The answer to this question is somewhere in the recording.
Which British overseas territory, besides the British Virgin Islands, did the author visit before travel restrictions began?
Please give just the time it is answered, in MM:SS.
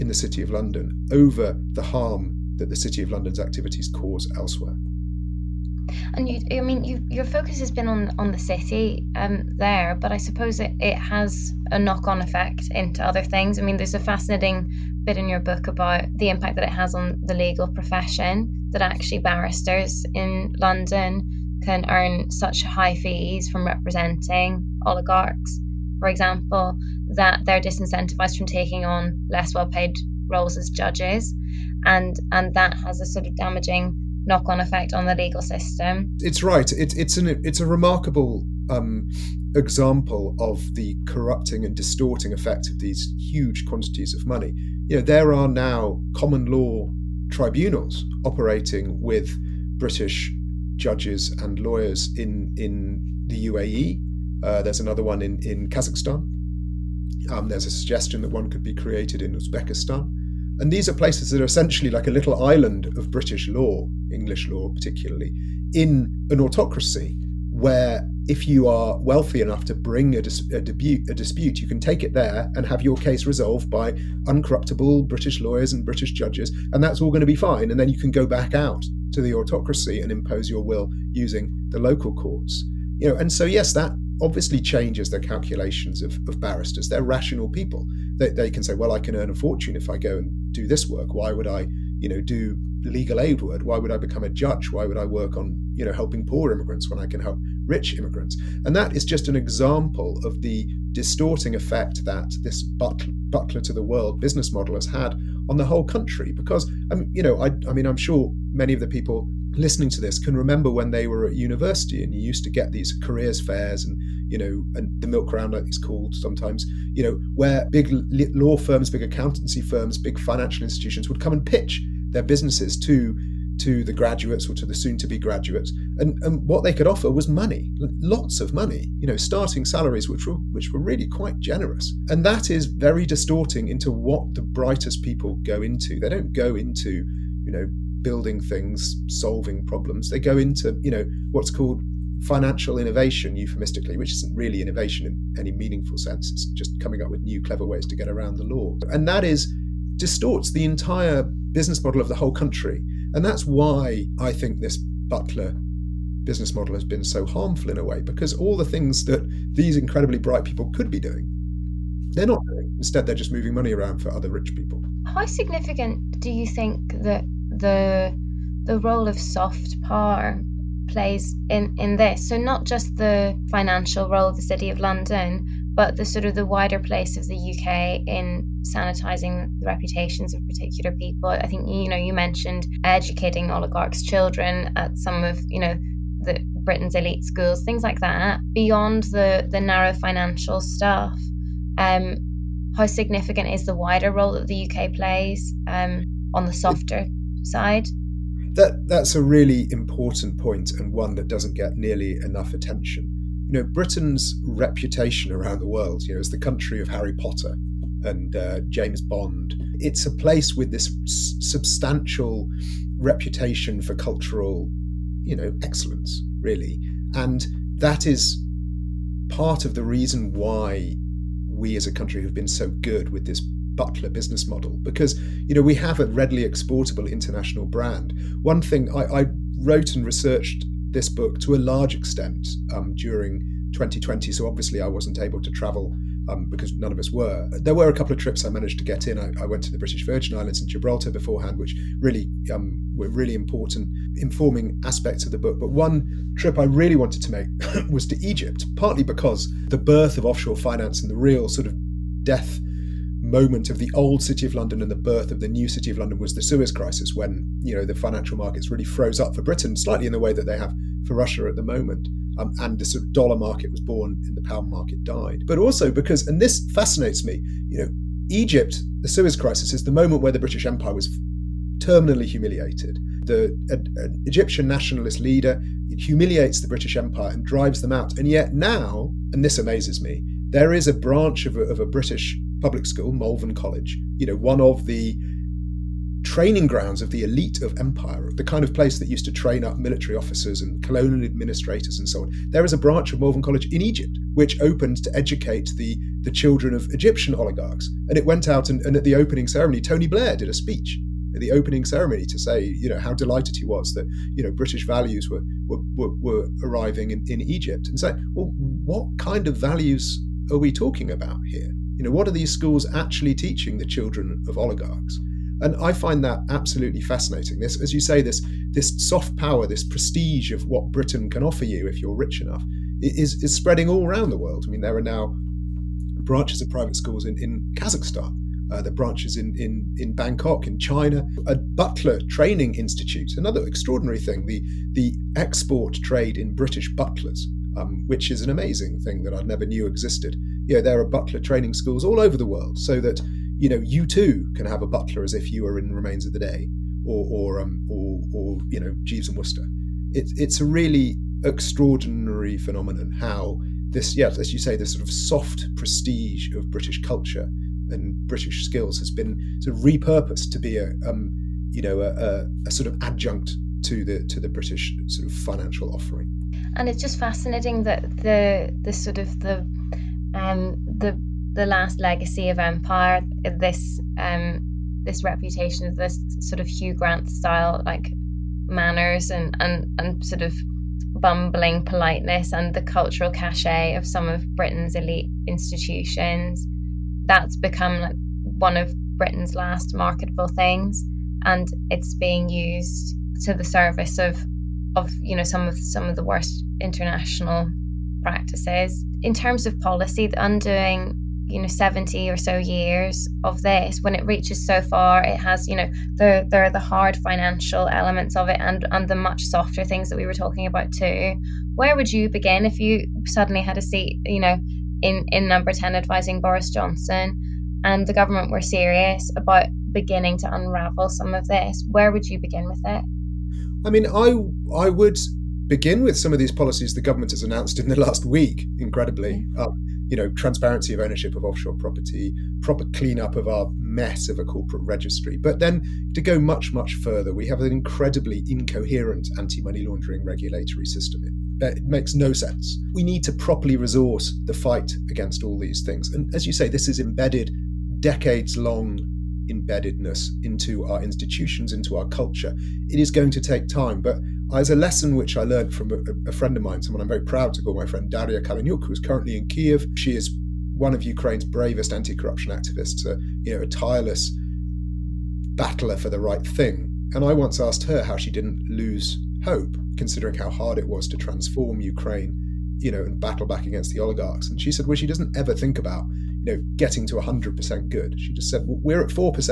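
04:00.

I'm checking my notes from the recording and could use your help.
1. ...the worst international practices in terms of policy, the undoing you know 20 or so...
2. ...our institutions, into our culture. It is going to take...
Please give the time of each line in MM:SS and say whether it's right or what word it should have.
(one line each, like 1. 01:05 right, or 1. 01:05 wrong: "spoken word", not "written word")
1. 06:36 wrong: "70", not "20"
2. 07:30 right.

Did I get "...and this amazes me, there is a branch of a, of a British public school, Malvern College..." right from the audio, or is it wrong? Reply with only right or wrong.
right.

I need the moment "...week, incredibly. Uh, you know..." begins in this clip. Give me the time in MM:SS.
07:08.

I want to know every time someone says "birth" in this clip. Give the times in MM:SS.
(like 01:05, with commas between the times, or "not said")
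04:09, 04:14.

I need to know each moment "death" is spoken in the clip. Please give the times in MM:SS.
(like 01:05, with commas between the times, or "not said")
04:12.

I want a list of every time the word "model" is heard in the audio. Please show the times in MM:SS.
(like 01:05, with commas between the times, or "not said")
01:44, 02:31, 02:36, 03:44.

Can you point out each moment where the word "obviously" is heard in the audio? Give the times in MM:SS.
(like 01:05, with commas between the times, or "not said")
01:24, 03:54.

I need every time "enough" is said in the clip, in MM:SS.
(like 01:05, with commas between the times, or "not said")
01:09, 03:22, 05:22.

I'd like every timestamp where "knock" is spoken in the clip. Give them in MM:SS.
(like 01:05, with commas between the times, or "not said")
00:11, 00:34.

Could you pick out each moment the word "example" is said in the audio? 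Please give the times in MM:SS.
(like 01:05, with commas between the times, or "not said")
00:26, 00:39, 01:39.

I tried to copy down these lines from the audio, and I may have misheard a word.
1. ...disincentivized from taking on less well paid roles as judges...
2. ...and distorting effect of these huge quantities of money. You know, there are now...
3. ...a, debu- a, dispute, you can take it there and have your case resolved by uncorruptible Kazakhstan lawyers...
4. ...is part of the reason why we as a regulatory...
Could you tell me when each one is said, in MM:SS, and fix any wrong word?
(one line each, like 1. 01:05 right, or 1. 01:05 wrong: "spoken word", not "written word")
1. 00:27 right
2. 00:41 right
3. 01:10 wrong: "British", not "Kazakhstan"
4. 03:38 wrong: "country", not "regulatory".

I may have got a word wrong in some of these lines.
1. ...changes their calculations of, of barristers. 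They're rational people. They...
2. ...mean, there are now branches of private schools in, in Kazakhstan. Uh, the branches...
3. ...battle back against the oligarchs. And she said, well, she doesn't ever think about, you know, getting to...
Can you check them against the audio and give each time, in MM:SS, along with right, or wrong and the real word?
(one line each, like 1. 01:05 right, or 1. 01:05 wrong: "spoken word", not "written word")
1. 01:24 right
2. 05:24 right
3. 07:53 right.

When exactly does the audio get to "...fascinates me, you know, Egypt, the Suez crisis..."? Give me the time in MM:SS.
04:26.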